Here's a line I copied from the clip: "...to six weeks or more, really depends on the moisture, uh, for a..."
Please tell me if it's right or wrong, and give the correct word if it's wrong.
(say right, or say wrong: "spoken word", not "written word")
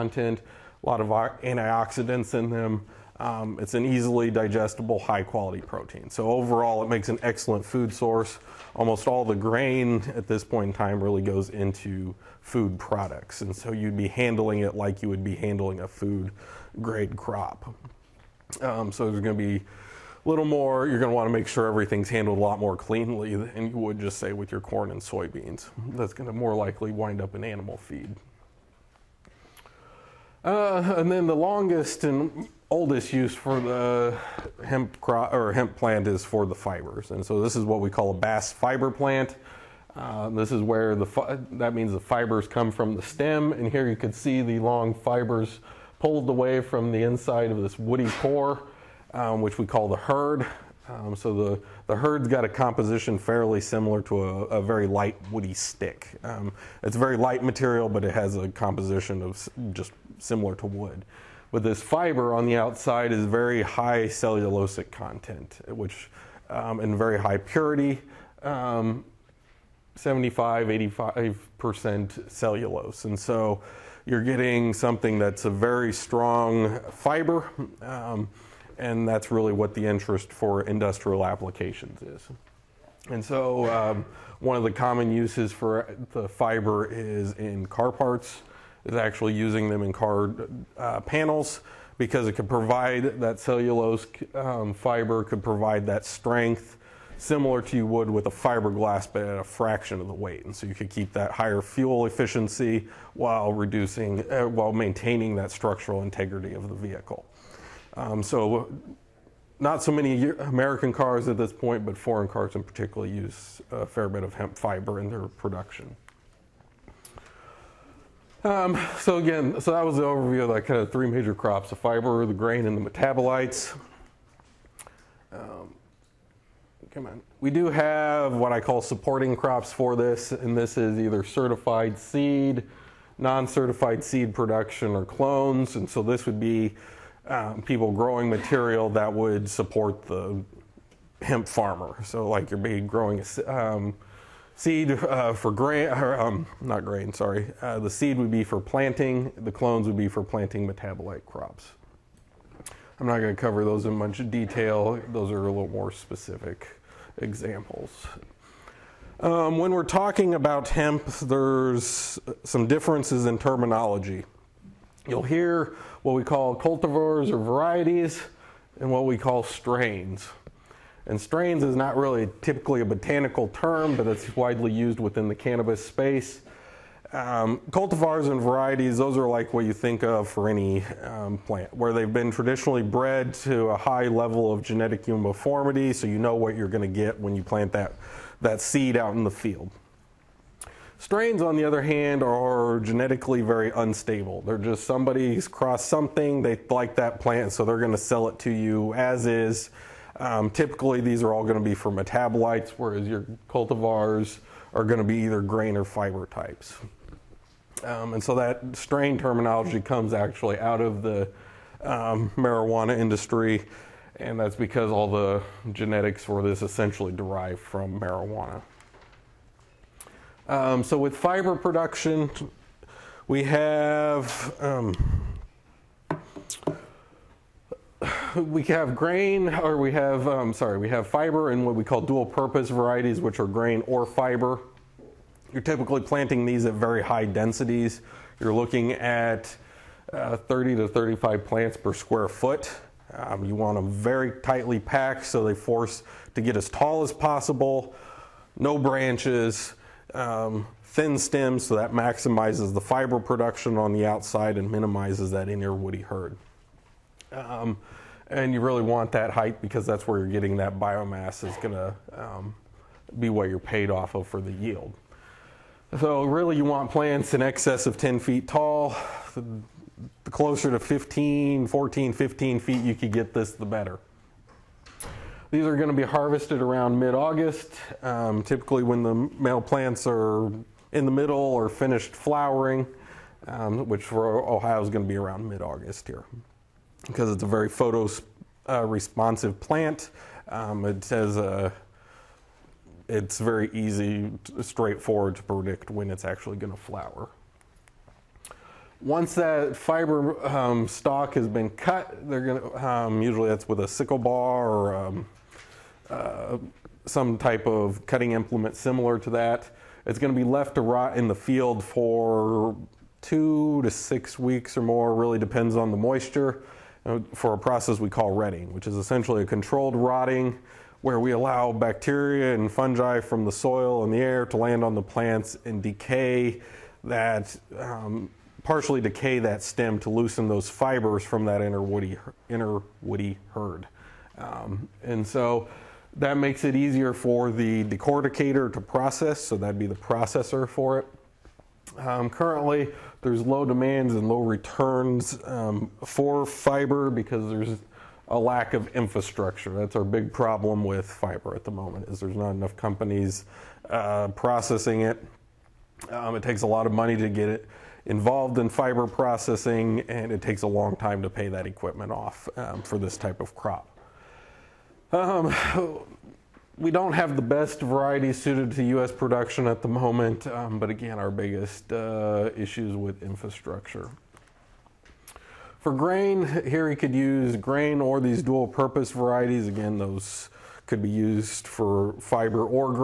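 right.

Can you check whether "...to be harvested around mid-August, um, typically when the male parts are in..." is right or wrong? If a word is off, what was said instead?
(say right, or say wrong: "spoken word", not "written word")
wrong: "plants", not "parts".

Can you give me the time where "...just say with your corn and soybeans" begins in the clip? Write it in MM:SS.
00:23.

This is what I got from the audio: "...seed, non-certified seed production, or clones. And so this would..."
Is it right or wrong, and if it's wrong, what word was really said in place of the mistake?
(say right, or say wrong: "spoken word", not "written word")
right.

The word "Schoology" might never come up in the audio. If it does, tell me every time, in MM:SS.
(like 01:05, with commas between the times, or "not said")
not said.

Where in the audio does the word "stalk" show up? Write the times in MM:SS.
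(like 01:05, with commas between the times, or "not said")
05:00.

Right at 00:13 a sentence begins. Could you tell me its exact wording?
And so, you'd be handling it like you would be handling a food grade crop.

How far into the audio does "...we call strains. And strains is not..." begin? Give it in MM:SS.
02:49.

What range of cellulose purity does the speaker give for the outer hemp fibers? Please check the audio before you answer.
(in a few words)
75-85%.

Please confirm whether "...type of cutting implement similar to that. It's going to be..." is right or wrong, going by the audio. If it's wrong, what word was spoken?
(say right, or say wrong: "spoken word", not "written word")
right.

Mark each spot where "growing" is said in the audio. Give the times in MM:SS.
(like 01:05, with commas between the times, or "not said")
02:17, 02:22.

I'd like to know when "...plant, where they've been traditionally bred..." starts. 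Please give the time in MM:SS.
03:01.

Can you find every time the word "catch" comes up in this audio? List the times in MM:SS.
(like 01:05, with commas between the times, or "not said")
not said.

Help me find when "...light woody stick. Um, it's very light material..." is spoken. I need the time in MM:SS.
00:54.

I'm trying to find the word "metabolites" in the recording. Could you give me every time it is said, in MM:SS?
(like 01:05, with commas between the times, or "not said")
02:02, 02:30, 03:21.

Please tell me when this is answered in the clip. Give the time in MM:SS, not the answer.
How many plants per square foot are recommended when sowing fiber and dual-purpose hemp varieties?
04:00.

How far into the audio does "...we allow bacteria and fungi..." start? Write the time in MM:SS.
05:21.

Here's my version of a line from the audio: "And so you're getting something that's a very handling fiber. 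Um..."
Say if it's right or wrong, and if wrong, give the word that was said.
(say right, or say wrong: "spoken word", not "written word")
wrong: "strong", not "handling".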